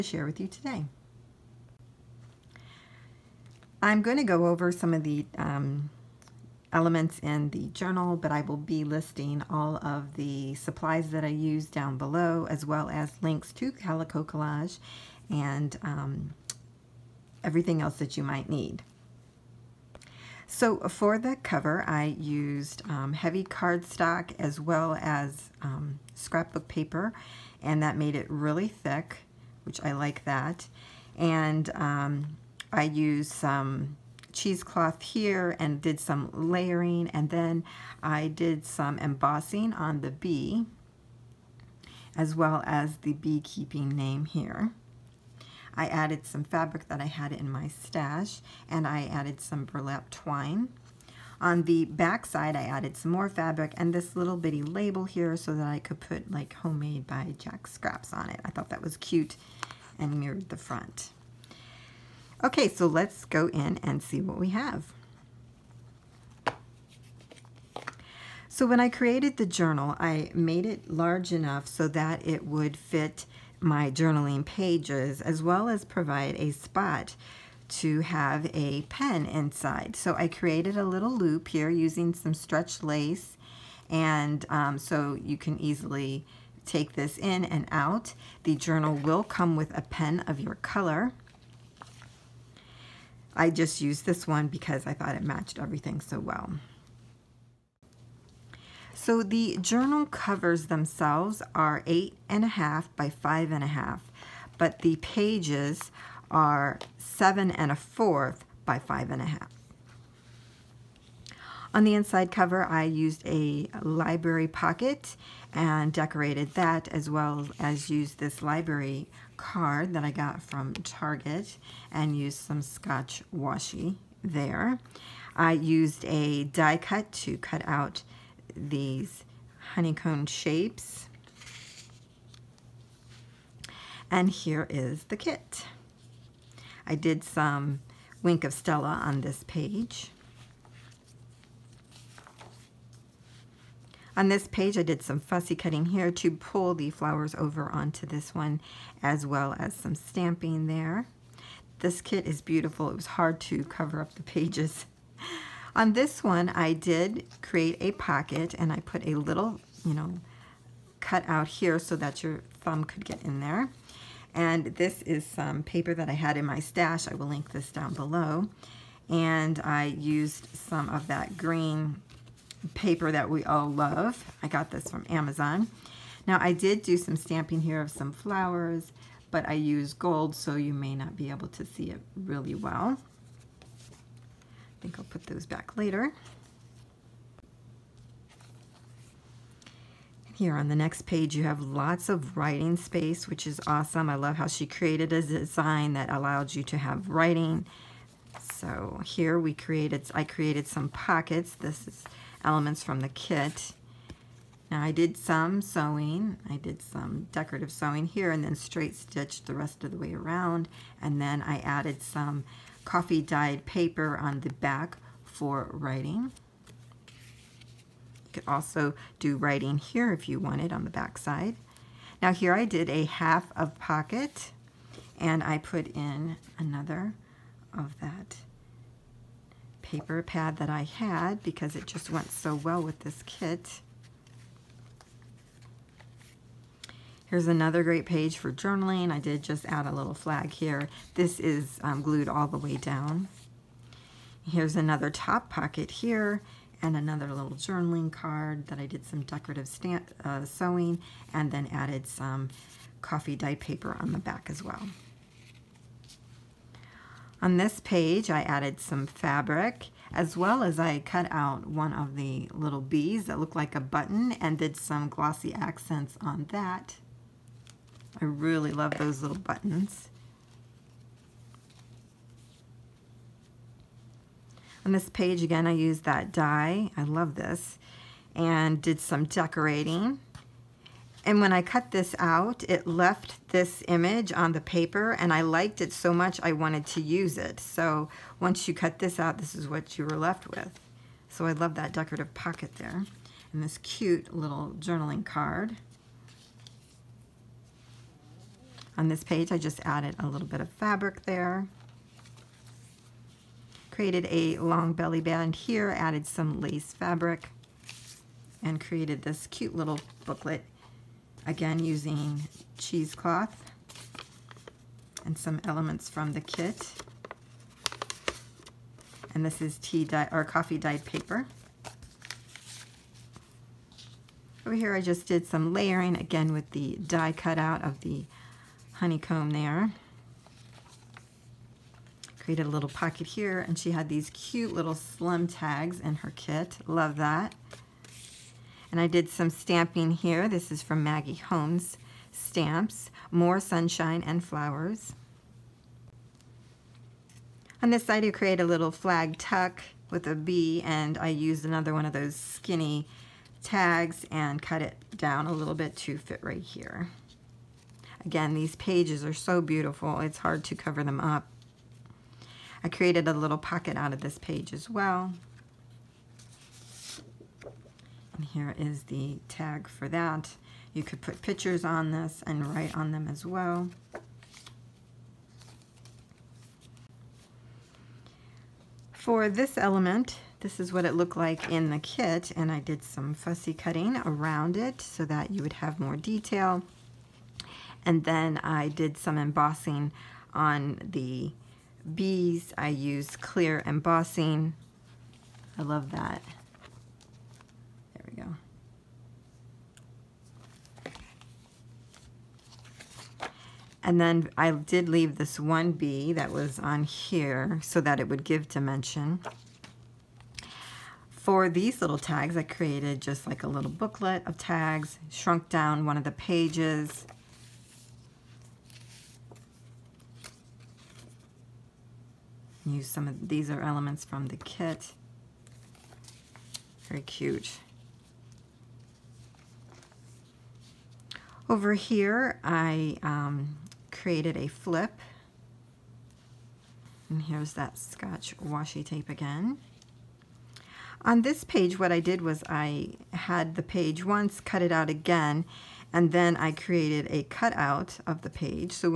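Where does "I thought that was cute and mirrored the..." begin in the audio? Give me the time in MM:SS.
00:58.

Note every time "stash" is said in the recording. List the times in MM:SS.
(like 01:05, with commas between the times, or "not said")
00:47, 02:46.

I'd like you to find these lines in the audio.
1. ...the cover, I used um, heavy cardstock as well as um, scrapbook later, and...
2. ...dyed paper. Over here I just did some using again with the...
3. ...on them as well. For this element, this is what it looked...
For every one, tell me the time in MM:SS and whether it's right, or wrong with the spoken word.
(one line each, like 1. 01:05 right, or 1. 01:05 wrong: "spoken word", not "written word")
1. 00:21 wrong: "paper", not "later"
2. 05:20 wrong: "layering", not "using"
3. 06:12 right.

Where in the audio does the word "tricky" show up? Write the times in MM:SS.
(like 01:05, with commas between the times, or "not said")
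not said.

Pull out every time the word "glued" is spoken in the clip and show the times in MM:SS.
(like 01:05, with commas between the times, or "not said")
04:02.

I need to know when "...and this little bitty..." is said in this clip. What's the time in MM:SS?
00:53.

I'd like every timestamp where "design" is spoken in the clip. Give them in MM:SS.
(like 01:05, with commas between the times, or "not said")
03:15.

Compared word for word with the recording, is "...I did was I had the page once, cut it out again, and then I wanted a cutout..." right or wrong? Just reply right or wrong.
wrong.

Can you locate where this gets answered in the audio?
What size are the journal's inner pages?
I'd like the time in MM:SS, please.
01:46.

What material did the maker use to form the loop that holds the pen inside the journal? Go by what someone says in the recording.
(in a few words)
stretch lace.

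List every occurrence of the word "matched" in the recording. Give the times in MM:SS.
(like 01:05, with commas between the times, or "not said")
01:35.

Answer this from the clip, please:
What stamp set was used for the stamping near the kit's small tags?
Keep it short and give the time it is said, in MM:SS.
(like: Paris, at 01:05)
More Sunshine and Flowers, at 05:43.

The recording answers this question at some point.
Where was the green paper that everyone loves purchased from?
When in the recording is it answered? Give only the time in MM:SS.
02:55.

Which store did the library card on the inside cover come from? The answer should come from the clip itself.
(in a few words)
Target.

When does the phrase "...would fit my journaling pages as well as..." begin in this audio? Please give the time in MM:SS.
01:12.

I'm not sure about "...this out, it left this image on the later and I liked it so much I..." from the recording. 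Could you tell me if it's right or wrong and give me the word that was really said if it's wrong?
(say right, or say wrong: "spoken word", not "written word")
wrong: "paper", not "later".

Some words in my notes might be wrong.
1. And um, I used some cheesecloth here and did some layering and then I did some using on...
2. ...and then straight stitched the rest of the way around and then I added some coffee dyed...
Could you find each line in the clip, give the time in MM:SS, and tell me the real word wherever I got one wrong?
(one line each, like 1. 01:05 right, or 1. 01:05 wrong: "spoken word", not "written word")
1. 00:31 wrong: "embossing", not "using"
2. 03:28 right.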